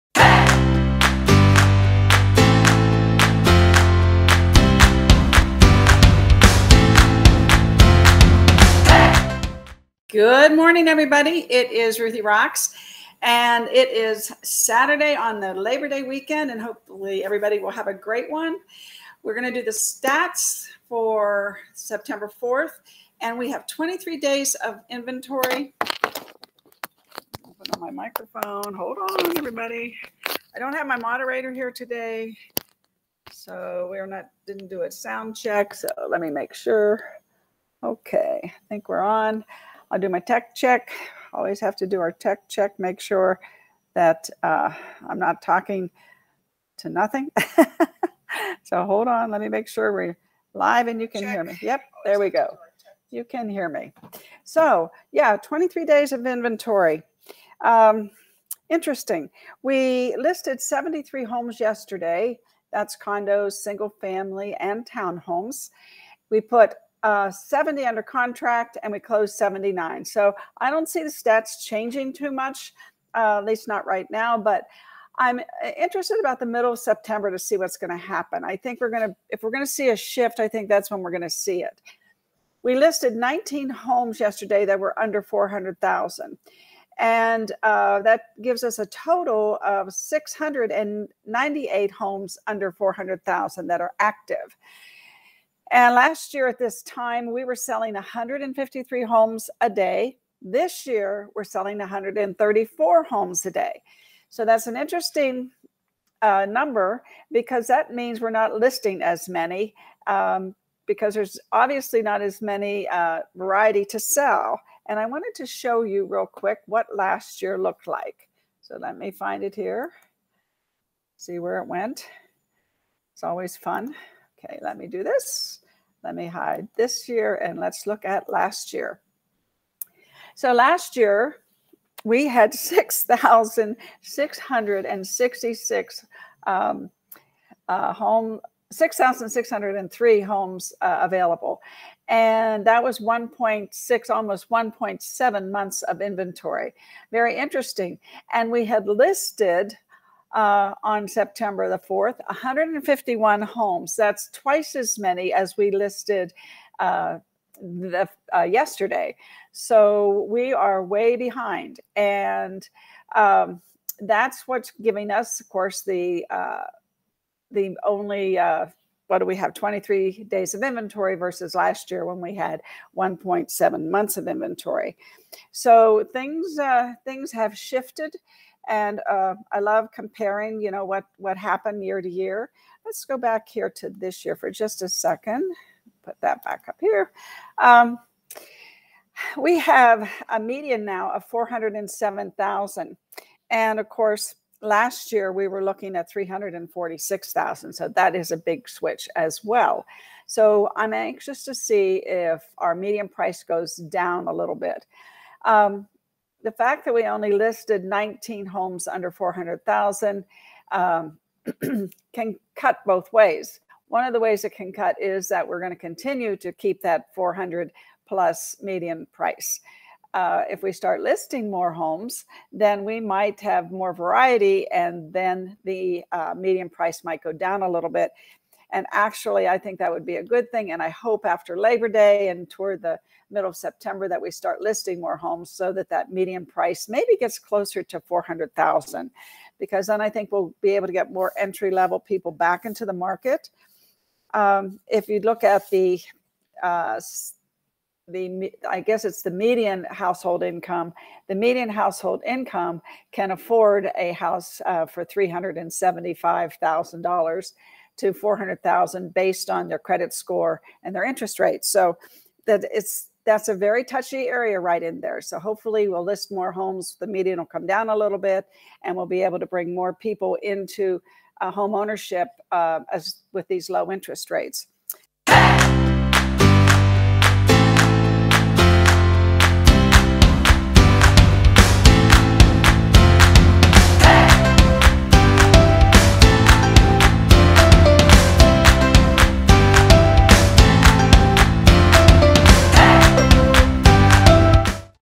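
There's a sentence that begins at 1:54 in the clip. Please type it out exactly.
And I wanted to show you real quick what last year looked like.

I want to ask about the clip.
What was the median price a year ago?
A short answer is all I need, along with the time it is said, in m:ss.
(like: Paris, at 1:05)
346,000, at 3:16.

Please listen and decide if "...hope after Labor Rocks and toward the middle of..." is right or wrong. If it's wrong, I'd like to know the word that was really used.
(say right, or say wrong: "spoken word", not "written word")
wrong: "Day", not "Rocks".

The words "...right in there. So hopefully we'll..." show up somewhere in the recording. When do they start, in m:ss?
4:24.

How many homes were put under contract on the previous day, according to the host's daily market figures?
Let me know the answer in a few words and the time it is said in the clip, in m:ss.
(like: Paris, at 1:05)
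70, at 1:07.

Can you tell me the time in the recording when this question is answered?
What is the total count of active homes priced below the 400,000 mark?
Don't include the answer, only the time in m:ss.
1:29.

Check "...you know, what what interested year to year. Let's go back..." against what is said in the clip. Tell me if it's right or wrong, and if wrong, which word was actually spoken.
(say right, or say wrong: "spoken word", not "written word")
wrong: "happened", not "interested".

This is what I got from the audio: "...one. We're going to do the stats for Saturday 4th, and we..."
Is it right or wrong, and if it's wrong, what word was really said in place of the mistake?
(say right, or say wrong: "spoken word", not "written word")
wrong: "September", not "Saturday".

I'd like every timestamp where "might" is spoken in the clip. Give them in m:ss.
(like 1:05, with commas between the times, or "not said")
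3:42, 3:47.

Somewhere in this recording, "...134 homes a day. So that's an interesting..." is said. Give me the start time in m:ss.
1:41.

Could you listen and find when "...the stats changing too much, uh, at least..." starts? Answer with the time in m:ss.
1:11.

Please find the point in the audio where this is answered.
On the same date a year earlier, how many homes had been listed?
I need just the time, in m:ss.
2:32.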